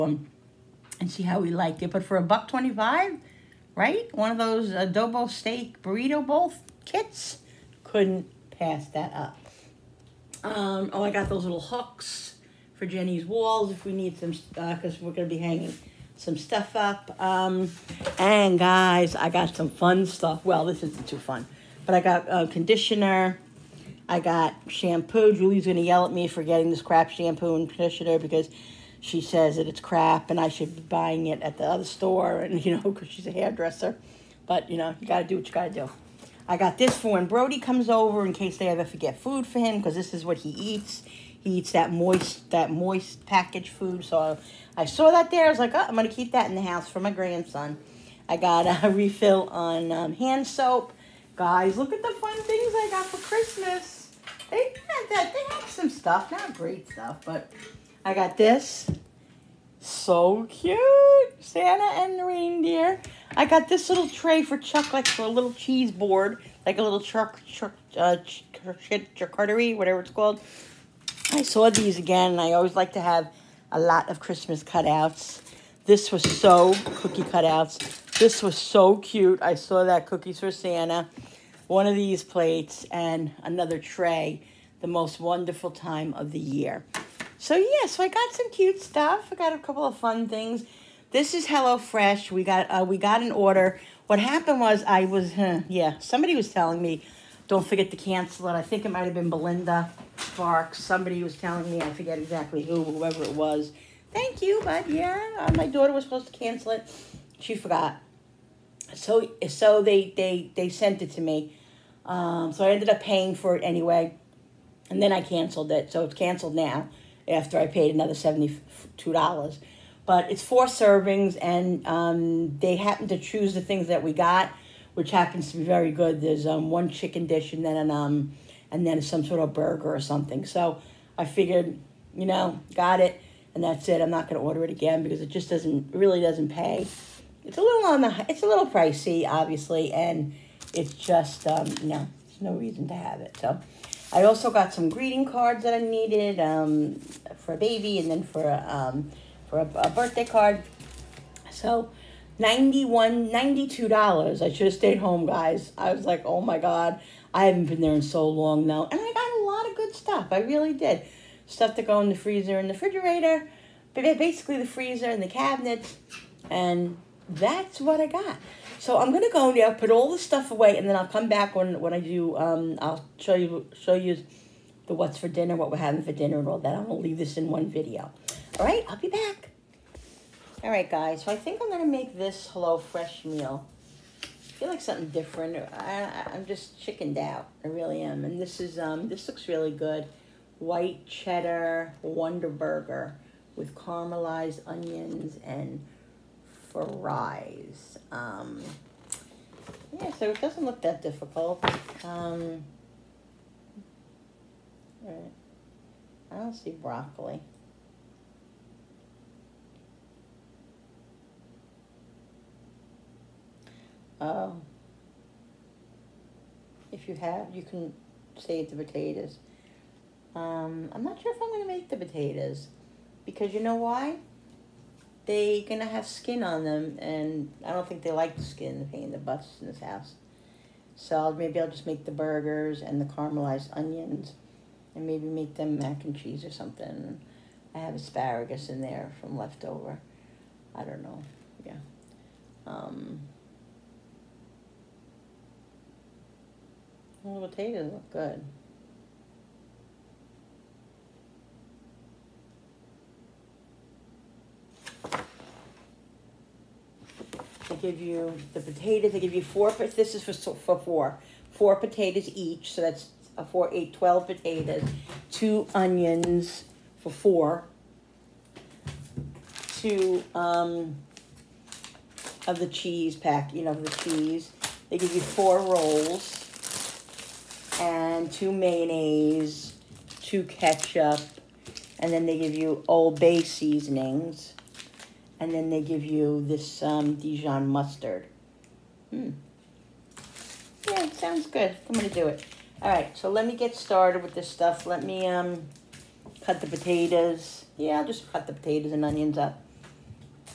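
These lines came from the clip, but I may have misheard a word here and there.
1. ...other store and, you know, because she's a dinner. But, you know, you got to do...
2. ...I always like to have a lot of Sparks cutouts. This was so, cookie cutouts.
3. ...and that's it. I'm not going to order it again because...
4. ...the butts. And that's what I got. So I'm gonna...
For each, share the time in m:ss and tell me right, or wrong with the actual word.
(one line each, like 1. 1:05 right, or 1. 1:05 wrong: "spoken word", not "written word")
1. 0:31 wrong: "hairdresser", not "dinner"
2. 1:12 wrong: "Christmas", not "Sparks"
3. 2:13 right
4. 2:45 wrong: "cabinets", not "butts".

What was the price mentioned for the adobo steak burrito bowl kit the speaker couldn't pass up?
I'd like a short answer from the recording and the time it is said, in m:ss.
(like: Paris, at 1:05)
$1.25, at 0:02.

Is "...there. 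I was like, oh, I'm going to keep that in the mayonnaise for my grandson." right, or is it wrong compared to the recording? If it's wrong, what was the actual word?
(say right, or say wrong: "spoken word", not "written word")
wrong: "house", not "mayonnaise".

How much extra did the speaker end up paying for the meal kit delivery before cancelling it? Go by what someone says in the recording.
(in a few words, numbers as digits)
$72.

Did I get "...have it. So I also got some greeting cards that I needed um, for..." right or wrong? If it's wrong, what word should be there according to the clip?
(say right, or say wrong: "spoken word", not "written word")
right.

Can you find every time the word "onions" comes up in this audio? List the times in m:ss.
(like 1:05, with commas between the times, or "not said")
3:14, 3:53, 4:25, 4:59.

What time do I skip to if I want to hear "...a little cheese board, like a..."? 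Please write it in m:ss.
1:05.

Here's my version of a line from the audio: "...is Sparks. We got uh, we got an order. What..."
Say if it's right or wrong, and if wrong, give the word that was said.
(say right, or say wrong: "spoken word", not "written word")
wrong: "HelloFresh", not "Sparks".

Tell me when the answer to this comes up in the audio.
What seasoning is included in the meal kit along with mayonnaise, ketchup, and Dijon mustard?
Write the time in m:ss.
4:42.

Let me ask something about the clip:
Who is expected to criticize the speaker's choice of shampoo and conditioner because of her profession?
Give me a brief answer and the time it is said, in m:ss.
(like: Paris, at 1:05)
Julie, at 0:25.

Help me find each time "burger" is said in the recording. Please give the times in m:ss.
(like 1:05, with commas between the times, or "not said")
2:09, 3:12, 3:52.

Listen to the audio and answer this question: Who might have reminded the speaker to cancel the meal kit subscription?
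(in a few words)
Belinda Sparks.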